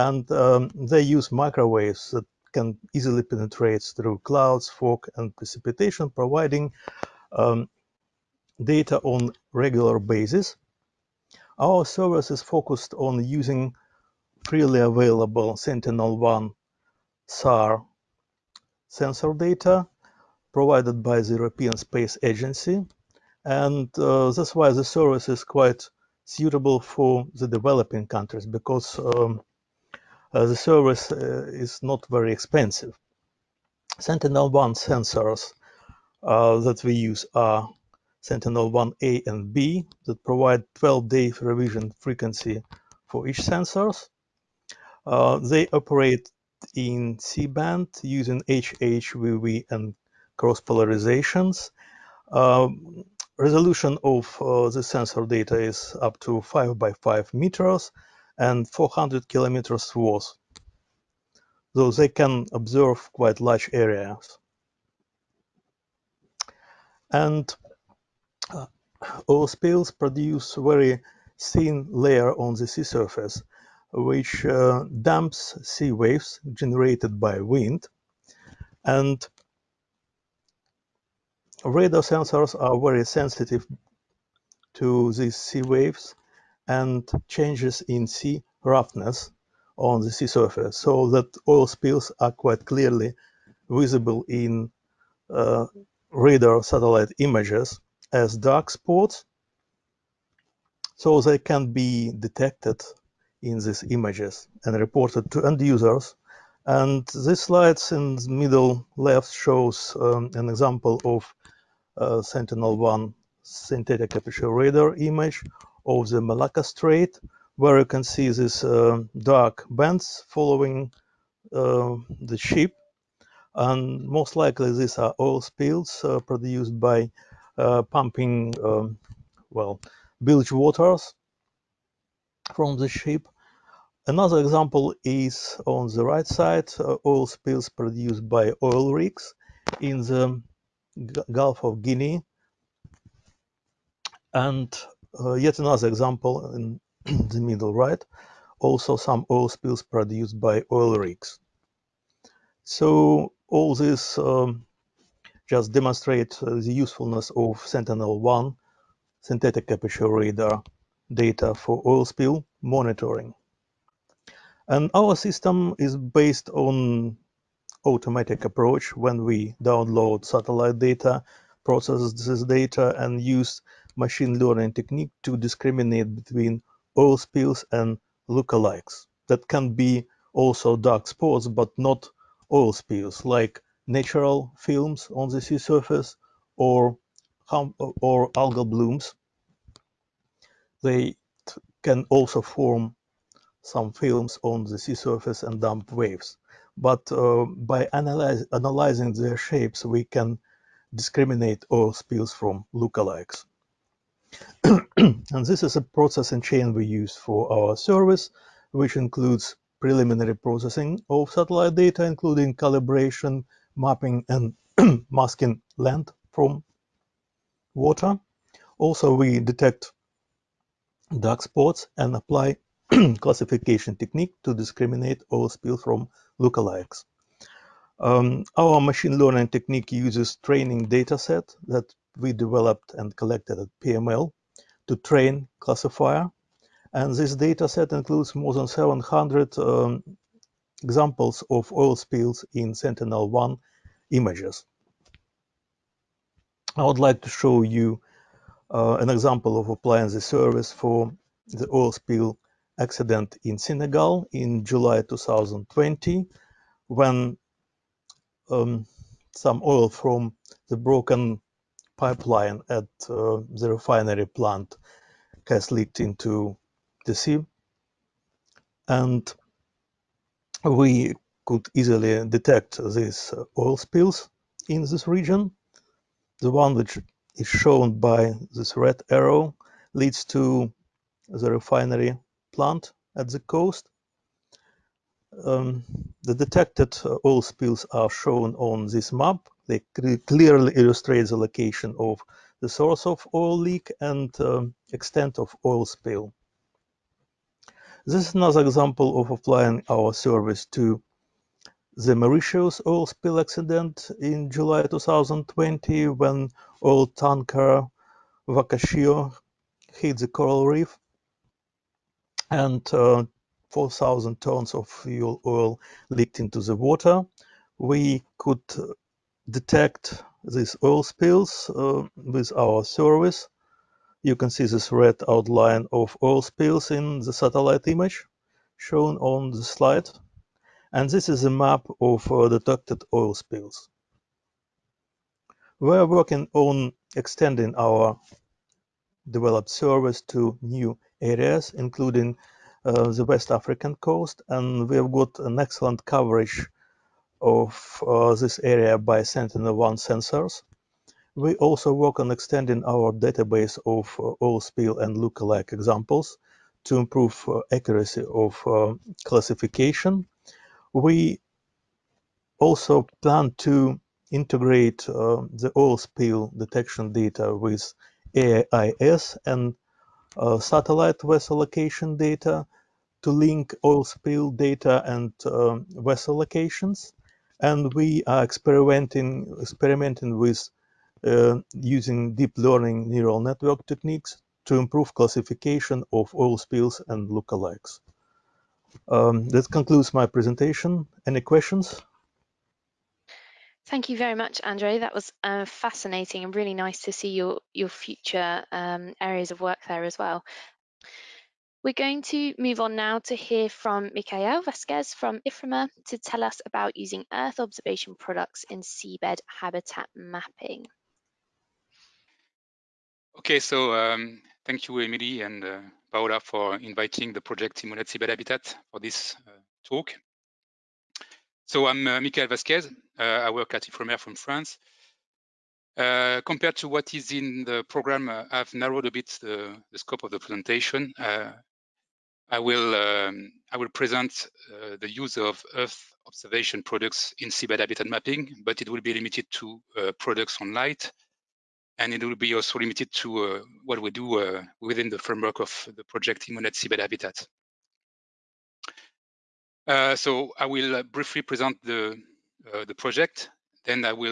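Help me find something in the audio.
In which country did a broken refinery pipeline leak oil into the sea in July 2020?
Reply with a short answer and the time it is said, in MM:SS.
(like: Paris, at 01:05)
Senegal, at 04:13.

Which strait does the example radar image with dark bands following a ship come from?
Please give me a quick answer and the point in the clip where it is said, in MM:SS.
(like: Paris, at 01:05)
Malacca Strait, at 01:56.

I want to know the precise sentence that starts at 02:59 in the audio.
That can be also dark spots, but not oil spills, like natural films on the sea surface or, or algal blooms.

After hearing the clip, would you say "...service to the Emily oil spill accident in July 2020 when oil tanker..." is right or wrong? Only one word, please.
wrong.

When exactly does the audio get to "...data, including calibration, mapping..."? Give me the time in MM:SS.
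03:31.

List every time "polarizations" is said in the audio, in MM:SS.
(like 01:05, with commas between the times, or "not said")
00:50.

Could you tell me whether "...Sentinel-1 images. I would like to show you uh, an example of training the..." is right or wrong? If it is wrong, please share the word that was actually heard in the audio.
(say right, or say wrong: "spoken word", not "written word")
wrong: "applying", not "training".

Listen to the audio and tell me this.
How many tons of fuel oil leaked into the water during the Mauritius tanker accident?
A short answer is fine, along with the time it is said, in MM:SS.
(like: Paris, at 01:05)
4,000 tons, at 05:13.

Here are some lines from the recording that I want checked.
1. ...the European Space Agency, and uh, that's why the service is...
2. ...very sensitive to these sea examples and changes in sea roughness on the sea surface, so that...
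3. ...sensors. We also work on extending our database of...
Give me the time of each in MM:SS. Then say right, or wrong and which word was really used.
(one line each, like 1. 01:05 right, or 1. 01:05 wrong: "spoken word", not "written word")
1. 00:21 right
2. 01:22 wrong: "waves", not "examples"
3. 05:49 right.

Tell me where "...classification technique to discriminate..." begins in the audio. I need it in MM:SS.
03:43.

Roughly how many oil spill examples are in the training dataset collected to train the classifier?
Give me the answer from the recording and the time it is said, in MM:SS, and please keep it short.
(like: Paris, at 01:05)
more than 700, at 03:58.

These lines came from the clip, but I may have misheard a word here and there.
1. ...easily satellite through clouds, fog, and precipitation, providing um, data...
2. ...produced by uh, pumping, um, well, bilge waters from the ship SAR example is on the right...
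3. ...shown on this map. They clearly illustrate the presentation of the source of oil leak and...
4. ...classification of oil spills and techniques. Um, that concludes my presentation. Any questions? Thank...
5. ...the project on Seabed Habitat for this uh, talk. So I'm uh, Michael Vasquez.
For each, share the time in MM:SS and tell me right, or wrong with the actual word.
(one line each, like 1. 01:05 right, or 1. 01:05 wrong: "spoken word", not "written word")
1. 00:02 wrong: "penetrate", not "satellite"
2. 02:06 wrong: "Another", not "SAR"
3. 04:48 wrong: "location", not "presentation"
4. 06:25 wrong: "lookalikes", not "techniques"
5. 06:57 right.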